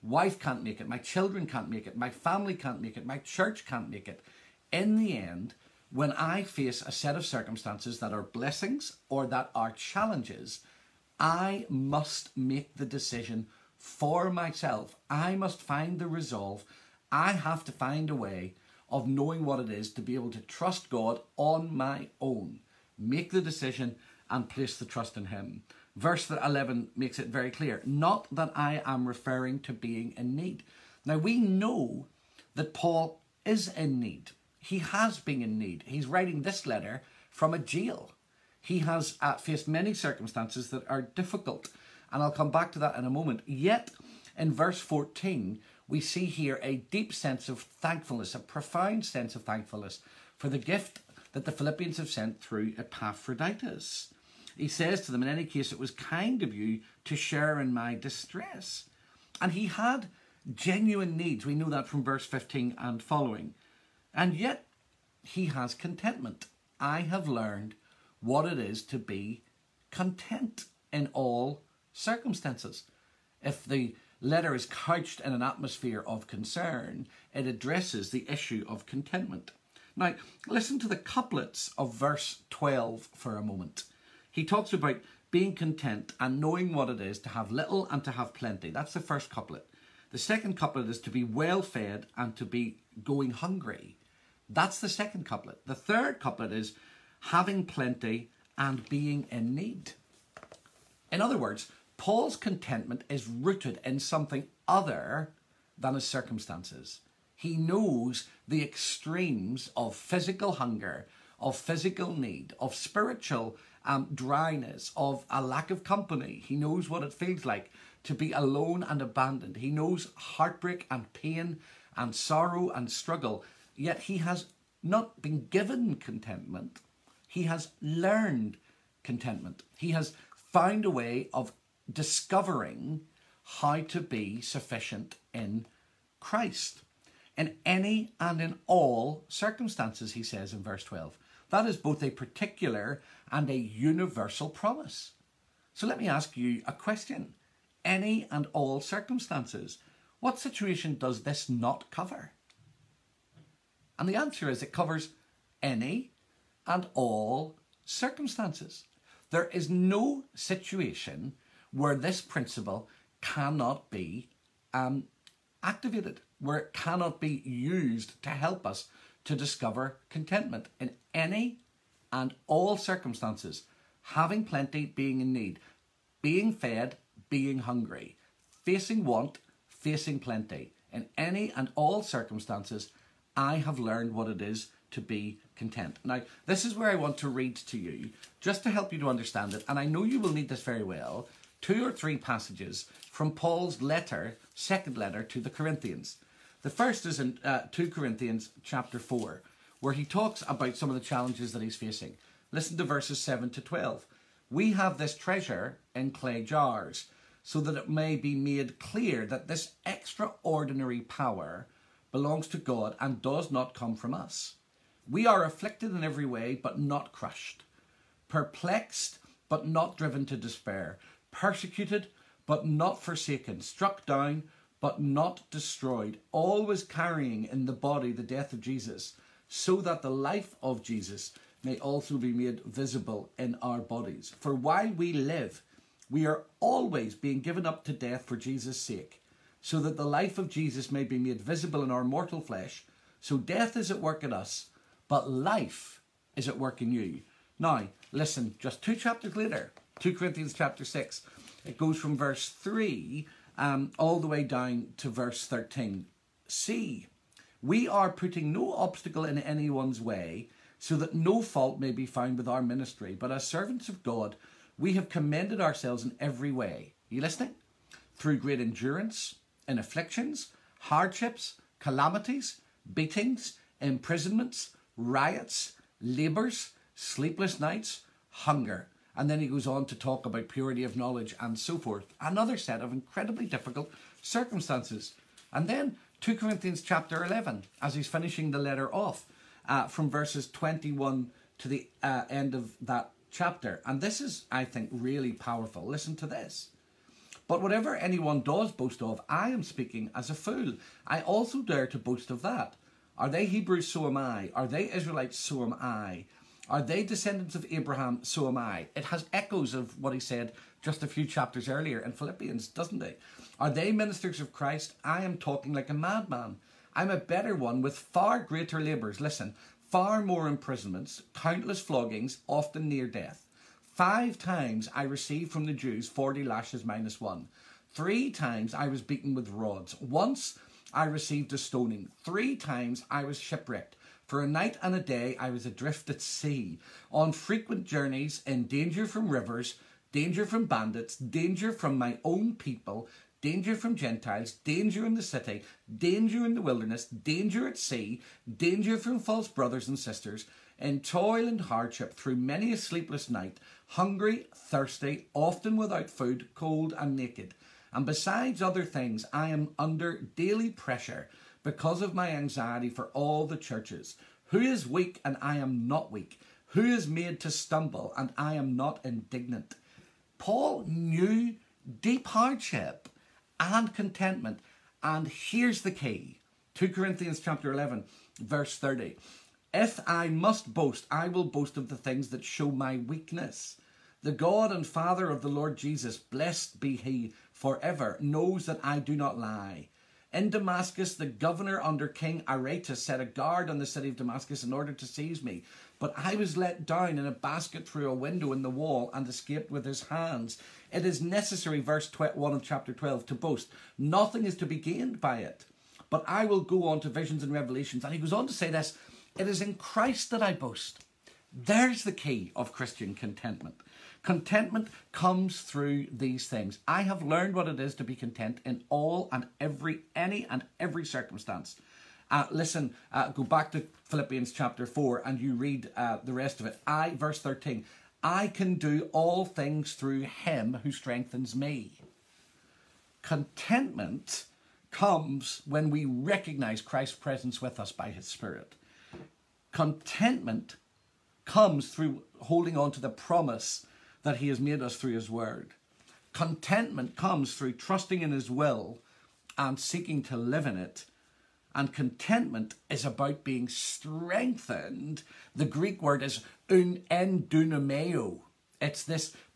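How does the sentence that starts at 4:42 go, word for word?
Another set of incredibly difficult circumstances.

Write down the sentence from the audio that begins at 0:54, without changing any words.
He says to them, In any case, it was kind of you to share in my distress.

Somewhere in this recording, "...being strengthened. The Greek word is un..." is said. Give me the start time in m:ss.
7:33.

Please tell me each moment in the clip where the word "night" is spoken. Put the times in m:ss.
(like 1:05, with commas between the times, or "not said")
4:37, 5:34, 5:53.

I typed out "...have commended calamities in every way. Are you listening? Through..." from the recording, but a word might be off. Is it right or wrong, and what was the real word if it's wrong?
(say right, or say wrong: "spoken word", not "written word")
wrong: "ourselves", not "calamities".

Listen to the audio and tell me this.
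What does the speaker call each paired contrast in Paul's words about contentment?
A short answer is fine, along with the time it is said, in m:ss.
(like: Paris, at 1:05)
couplets, at 1:20.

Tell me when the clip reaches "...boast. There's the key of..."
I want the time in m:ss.
6:50.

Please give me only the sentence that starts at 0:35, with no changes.
He's writing this letter from a jail.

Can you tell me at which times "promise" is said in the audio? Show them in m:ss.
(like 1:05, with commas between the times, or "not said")
2:24, 7:23.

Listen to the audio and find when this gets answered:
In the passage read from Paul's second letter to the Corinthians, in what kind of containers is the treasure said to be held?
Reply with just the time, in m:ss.
3:26.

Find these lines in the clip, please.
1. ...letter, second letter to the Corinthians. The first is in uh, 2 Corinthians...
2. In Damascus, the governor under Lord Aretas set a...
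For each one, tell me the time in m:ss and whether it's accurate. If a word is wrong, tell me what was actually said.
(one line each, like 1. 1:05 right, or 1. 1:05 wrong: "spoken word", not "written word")
1. 3:13 right
2. 6:30 wrong: "King", not "Lord".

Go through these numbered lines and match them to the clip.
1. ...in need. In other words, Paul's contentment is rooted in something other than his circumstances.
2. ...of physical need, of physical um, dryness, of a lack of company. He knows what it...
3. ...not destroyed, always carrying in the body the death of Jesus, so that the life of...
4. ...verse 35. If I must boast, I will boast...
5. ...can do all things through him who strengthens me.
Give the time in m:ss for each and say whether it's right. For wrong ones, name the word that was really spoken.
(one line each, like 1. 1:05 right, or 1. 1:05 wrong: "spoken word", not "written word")
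1. 1:39 right
2. 1:51 wrong: "spiritual", not "physical"
3. 3:45 right
4. 6:18 wrong: "30", not "35"
5. 7:08 right.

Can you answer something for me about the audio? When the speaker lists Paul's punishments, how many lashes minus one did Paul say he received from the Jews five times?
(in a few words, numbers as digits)
40.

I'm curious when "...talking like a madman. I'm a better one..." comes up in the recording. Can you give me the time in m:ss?
5:15.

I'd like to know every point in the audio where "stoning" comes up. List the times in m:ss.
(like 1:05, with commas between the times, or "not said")
5:31.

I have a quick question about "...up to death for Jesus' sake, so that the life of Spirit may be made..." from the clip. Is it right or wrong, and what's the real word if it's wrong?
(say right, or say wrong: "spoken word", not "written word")
wrong: "Jesus", not "Spirit".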